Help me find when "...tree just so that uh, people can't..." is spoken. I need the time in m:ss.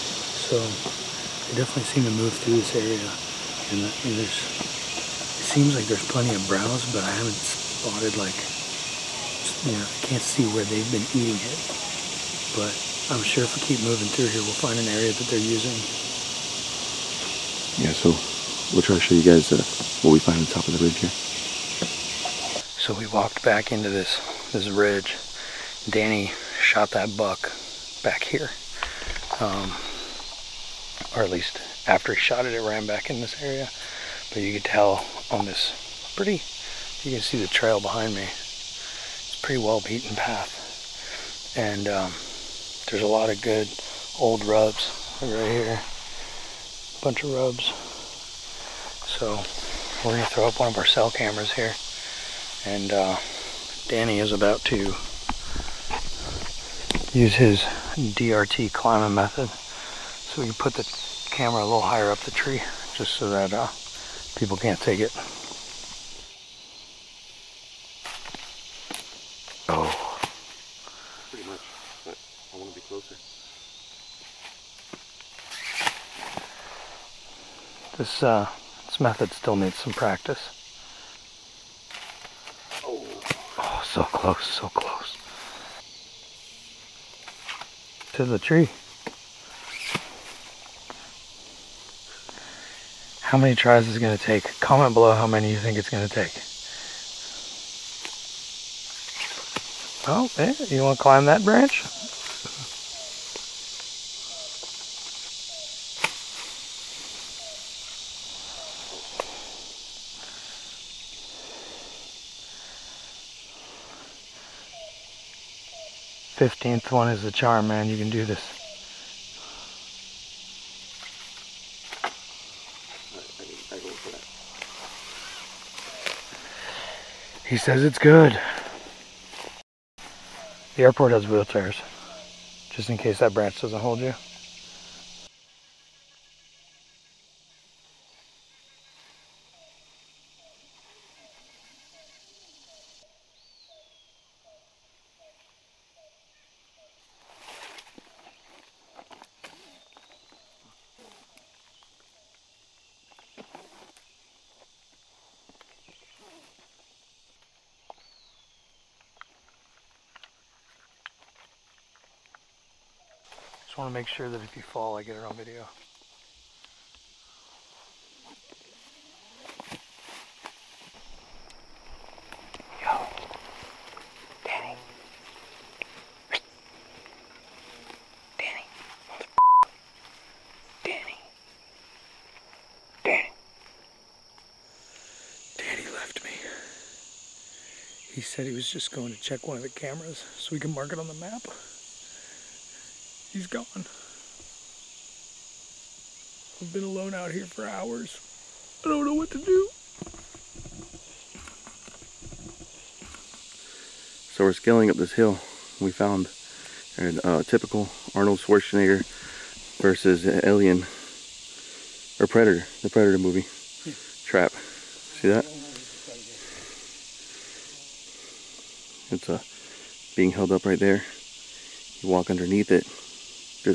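1:02.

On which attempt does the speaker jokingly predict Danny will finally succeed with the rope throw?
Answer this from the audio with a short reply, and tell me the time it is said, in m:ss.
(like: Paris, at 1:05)
15th, at 1:56.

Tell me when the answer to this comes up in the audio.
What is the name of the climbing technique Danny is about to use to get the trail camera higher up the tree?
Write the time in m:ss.
0:58.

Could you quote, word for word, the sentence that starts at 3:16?
I've been alone out here for hours.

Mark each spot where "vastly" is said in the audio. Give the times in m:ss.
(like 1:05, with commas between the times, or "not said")
not said.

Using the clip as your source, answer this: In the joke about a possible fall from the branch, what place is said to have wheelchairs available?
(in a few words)
The airport.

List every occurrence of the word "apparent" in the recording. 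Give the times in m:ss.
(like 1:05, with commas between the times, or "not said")
not said.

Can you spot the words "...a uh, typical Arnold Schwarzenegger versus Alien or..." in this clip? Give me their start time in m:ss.
3:26.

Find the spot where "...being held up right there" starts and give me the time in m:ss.
3:40.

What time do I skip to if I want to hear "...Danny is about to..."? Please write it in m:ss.
0:53.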